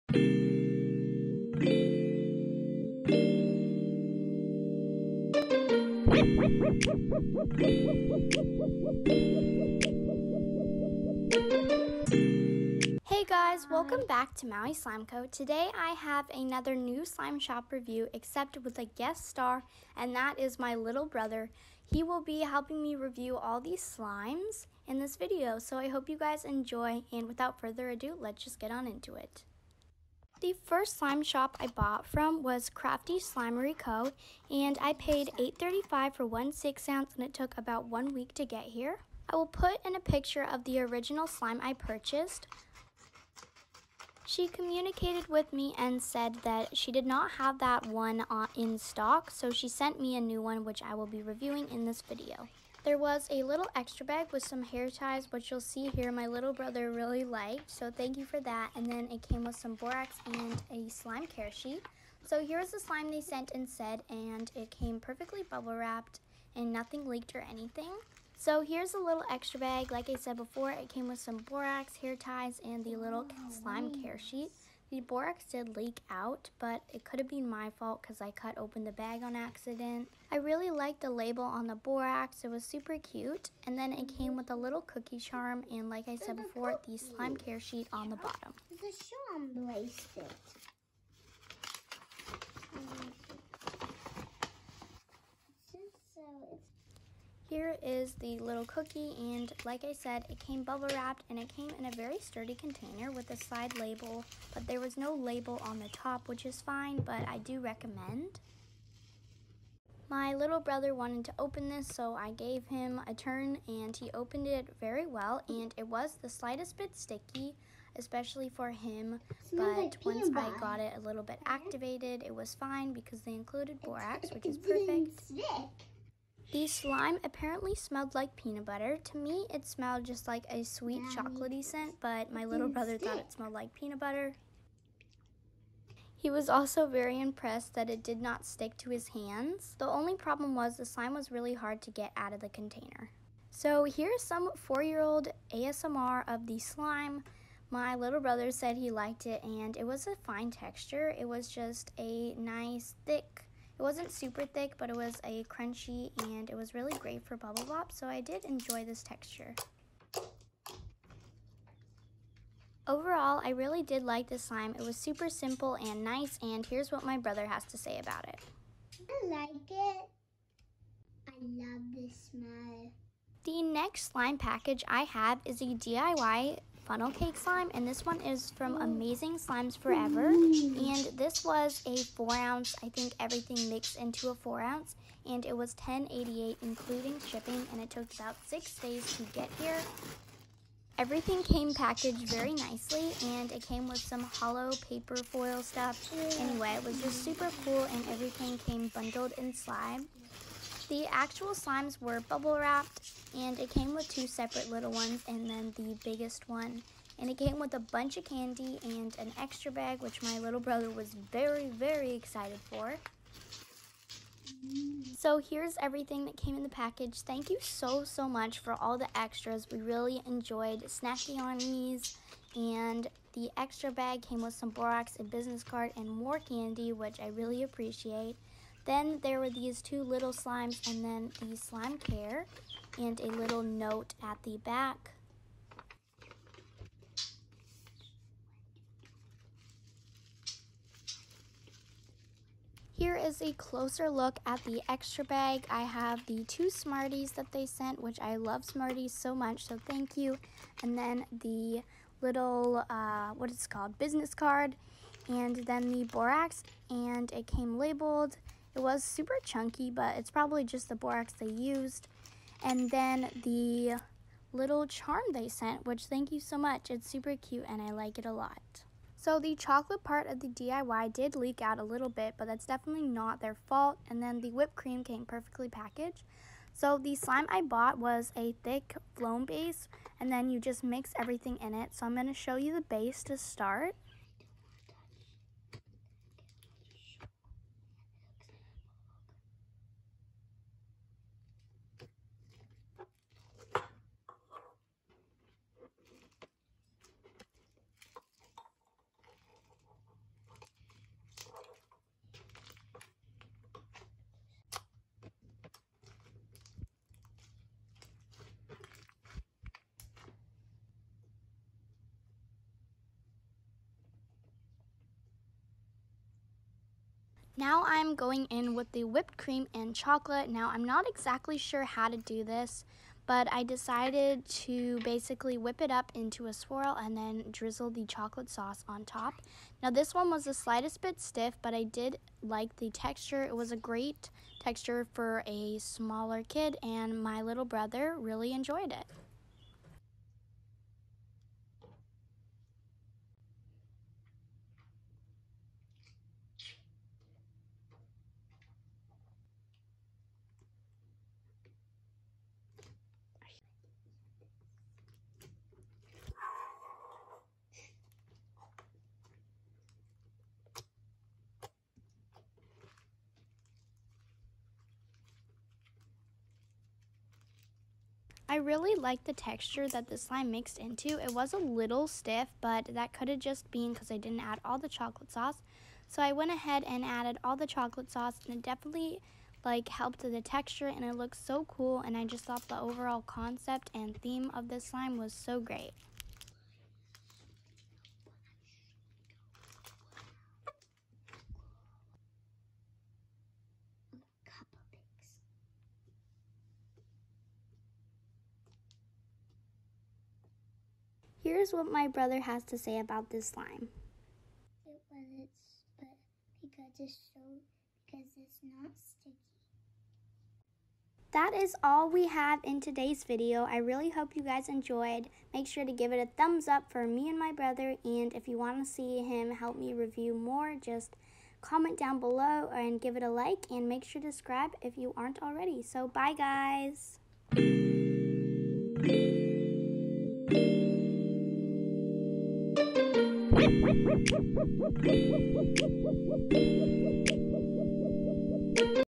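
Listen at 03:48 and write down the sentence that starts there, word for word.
Then there were these two little slimes and then the slime care and a little note at the back.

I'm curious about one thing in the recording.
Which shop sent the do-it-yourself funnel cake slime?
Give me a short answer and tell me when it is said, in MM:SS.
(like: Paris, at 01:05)
Amazing Slimes Forever, at 02:58.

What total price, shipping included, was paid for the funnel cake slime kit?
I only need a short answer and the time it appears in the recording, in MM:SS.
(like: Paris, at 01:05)
$10.88, at 03:05.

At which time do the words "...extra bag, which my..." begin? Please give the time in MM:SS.
03:29.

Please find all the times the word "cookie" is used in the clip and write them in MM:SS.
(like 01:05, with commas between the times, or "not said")
01:24, 01:38.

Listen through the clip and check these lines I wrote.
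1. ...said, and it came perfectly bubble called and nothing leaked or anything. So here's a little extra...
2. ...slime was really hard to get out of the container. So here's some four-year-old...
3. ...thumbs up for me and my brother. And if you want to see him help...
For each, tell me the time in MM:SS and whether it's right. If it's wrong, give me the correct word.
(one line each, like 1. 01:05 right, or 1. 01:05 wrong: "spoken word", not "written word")
1. 01:03 wrong: "wrapped", not "called"
2. 02:20 right
3. 06:56 right.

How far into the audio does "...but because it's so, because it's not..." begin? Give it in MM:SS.
06:45.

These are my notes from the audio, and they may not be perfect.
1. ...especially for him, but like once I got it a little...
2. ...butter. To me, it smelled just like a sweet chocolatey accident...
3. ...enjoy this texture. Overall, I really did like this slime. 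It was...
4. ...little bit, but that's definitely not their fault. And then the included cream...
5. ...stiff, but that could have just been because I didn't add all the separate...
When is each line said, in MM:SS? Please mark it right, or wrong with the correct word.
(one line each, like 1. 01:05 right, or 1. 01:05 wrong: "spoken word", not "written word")
1. 01:57 right
2. 02:08 wrong: "scent", not "accident"
3. 02:38 right
4. 04:31 wrong: "whipped", not "included"
5. 06:12 wrong: "chocolate", not "separate".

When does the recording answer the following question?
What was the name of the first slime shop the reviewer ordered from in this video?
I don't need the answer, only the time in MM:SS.
00:32.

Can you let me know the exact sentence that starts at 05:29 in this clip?
Now this one was the slightest bit stiff, but I did like the texture.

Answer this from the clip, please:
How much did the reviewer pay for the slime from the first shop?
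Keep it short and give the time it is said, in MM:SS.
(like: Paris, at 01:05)
$8.35, at 00:35.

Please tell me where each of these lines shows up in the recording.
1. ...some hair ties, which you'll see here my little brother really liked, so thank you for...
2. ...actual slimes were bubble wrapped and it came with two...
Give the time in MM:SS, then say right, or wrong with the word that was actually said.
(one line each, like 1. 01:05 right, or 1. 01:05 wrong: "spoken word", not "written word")
1. 00:54 right
2. 03:21 right.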